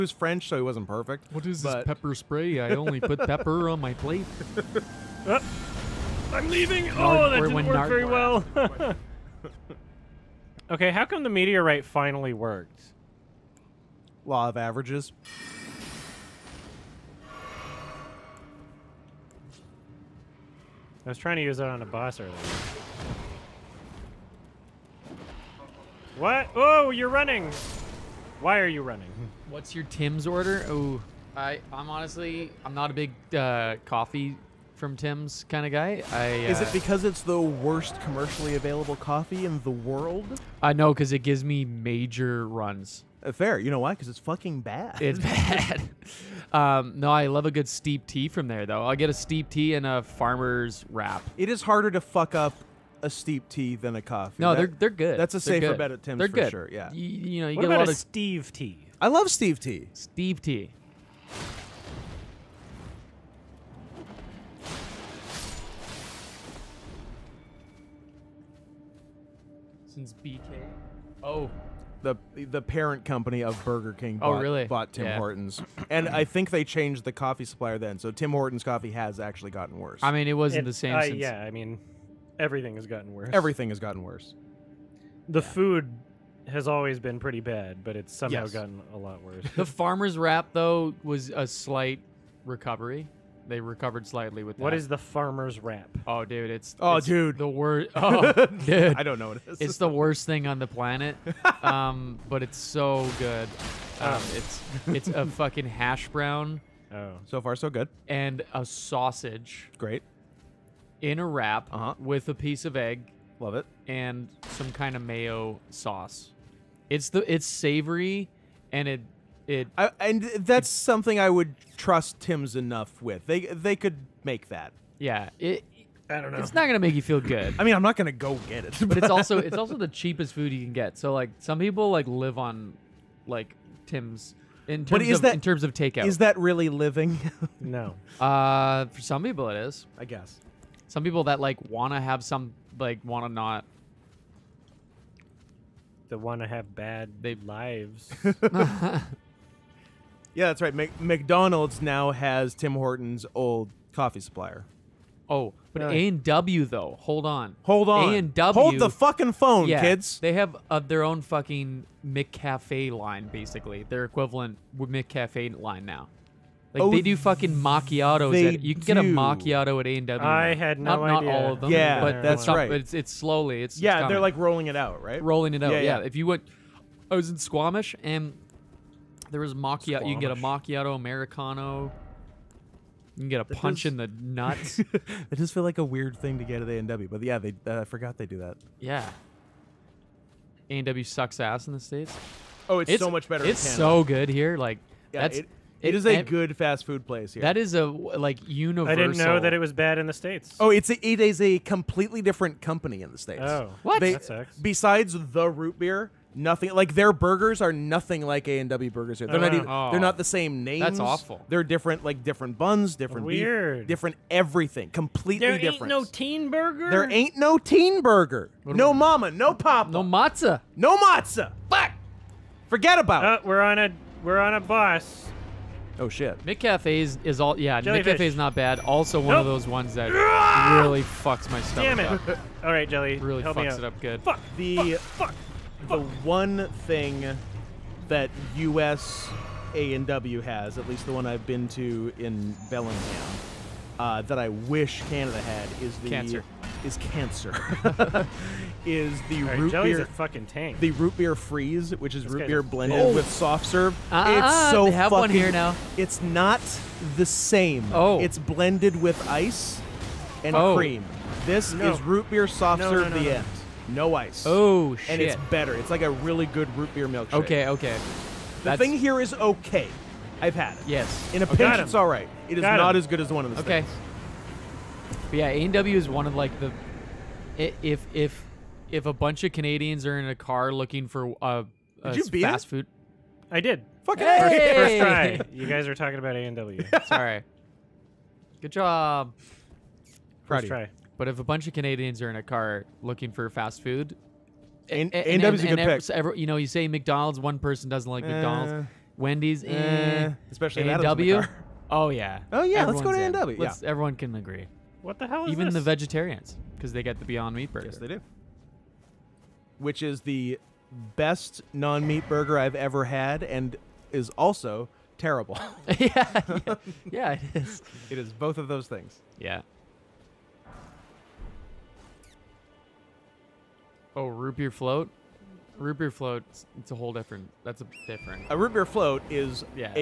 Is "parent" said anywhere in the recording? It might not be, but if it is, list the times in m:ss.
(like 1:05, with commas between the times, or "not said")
1:12.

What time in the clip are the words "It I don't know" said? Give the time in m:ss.
2:05.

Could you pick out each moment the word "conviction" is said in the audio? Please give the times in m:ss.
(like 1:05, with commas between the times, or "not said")
not said.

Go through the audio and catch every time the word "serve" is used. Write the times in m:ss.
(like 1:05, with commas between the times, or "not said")
4:13, 4:22.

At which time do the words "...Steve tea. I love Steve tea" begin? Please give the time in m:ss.
0:57.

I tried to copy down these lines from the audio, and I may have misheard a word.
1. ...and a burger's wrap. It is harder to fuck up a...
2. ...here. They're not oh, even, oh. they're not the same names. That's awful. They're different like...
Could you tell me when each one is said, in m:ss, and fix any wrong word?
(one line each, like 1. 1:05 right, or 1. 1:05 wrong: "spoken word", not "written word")
1. 0:49 wrong: "farmer", not "burger"
2. 3:29 right.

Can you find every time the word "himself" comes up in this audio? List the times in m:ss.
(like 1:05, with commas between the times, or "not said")
not said.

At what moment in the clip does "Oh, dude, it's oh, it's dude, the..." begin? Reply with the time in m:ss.
1:36.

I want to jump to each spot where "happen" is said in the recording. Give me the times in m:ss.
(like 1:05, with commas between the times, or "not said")
not said.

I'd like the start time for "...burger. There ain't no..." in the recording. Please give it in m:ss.
3:36.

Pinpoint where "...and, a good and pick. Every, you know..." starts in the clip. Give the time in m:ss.
4:55.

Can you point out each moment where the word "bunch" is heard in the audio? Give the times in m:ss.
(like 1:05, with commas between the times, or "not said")
4:39, 4:51.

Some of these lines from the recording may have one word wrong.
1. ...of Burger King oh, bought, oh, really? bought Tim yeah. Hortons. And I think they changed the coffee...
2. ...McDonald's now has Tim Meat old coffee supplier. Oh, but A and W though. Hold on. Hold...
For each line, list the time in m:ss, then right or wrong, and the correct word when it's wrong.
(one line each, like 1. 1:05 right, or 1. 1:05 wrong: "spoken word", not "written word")
1. 1:13 right
2. 2:30 wrong: "Hortons", not "Meat".